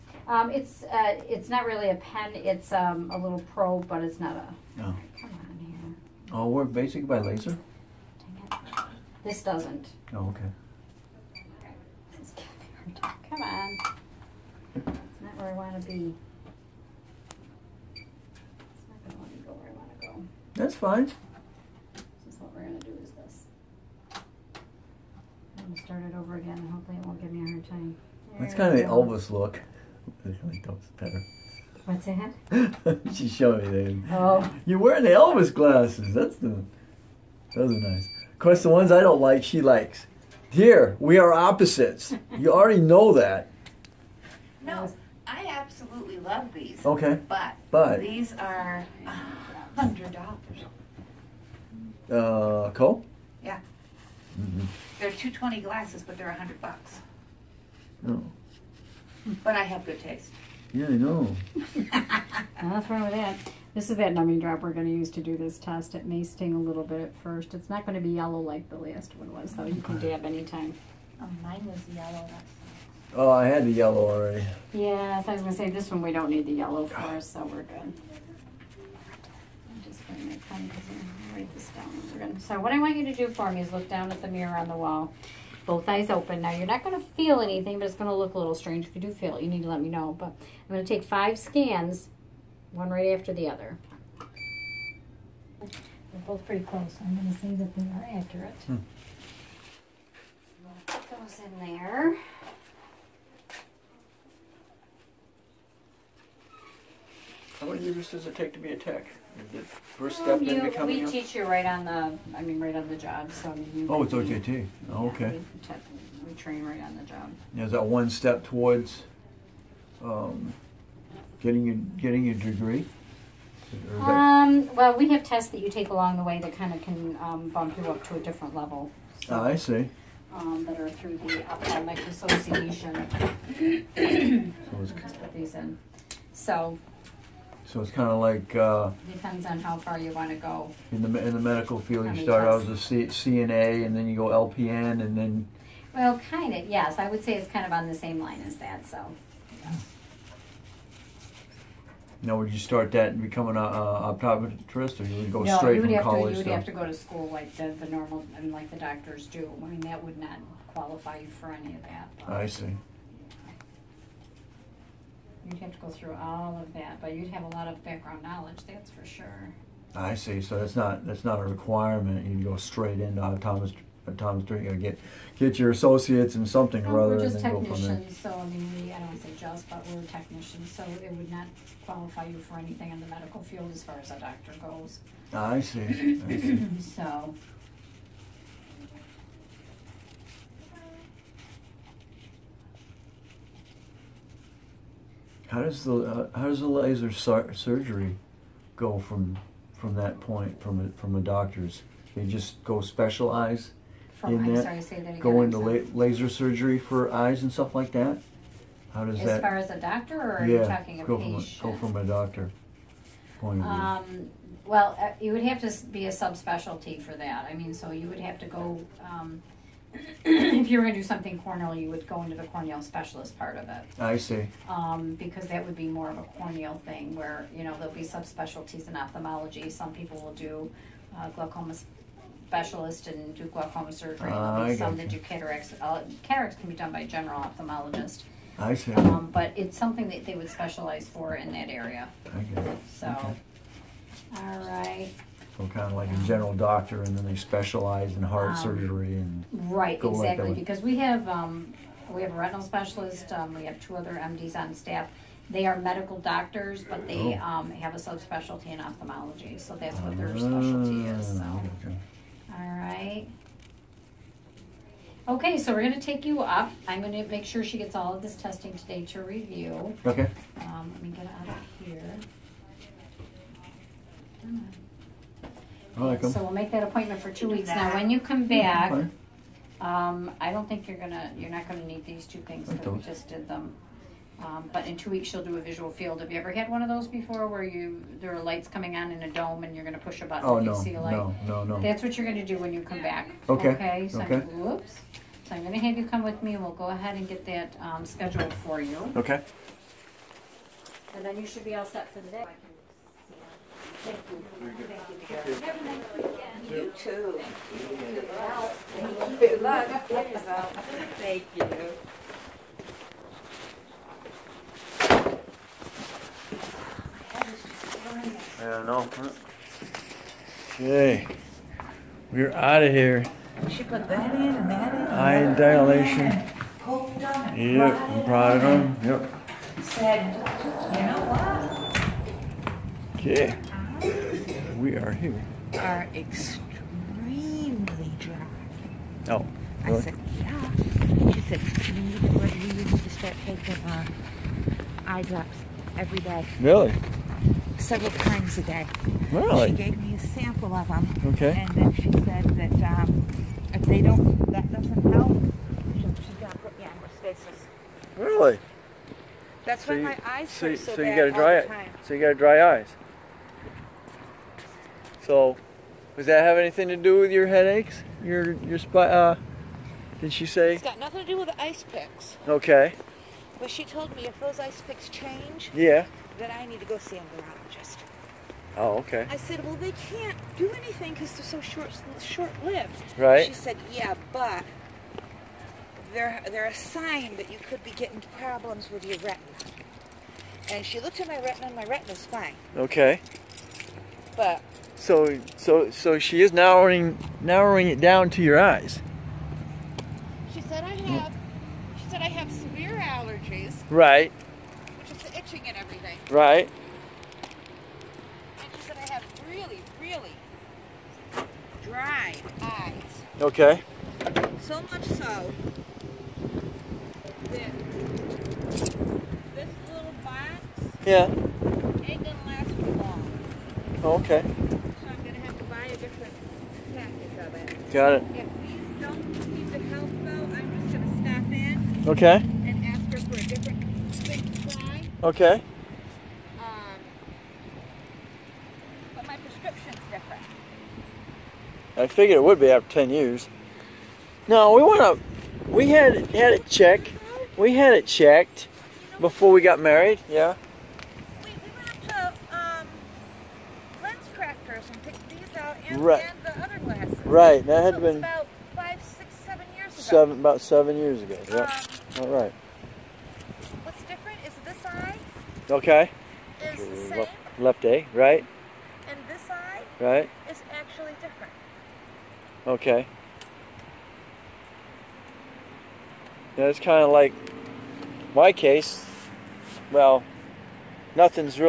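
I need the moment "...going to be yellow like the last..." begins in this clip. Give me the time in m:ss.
1:07.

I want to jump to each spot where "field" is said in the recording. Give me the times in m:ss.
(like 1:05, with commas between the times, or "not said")
2:21, 3:03, 4:45.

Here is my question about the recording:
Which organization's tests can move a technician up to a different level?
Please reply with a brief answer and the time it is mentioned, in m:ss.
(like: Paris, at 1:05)
the ophthalmic association, at 2:11.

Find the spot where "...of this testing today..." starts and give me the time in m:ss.
4:28.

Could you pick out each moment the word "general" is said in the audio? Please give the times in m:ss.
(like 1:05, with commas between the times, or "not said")
3:57, 4:06.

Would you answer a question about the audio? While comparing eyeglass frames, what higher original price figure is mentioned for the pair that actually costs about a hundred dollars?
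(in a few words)
220.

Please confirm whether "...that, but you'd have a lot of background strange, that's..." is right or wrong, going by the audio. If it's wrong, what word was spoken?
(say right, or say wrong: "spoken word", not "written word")
wrong: "knowledge", not "strange".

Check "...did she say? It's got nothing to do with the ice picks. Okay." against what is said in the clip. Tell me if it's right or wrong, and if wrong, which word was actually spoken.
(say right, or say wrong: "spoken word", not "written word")
right.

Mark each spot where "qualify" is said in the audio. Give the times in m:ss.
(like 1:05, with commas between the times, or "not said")
2:40, 3:01.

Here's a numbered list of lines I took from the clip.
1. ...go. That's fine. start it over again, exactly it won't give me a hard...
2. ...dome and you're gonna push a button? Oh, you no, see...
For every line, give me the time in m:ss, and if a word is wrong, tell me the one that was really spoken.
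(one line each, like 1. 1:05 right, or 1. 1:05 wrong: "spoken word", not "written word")
1. 0:20 wrong: "hopefully", not "exactly"
2. 4:49 right.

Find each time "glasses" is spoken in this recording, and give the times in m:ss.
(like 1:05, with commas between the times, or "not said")
0:35, 0:55.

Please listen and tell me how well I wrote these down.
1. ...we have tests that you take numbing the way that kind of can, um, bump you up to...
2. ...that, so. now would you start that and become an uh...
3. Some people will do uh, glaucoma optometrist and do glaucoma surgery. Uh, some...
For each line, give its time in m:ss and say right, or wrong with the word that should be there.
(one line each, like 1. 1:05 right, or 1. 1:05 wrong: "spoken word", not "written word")
1. 2:04 wrong: "along", not "numbing"
2. 2:28 right
3. 3:49 wrong: "specialist", not "optometrist".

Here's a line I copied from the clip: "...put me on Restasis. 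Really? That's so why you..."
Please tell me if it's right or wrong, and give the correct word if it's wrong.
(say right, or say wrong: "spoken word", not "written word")
right.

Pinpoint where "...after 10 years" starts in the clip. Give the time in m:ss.
7:22.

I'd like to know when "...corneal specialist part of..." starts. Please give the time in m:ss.
3:42.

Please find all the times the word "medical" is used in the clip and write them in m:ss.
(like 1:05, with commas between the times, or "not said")
2:21, 3:03, 4:15.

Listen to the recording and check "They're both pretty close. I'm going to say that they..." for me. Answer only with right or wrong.
right.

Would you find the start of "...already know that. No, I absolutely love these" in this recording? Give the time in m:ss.
0:42.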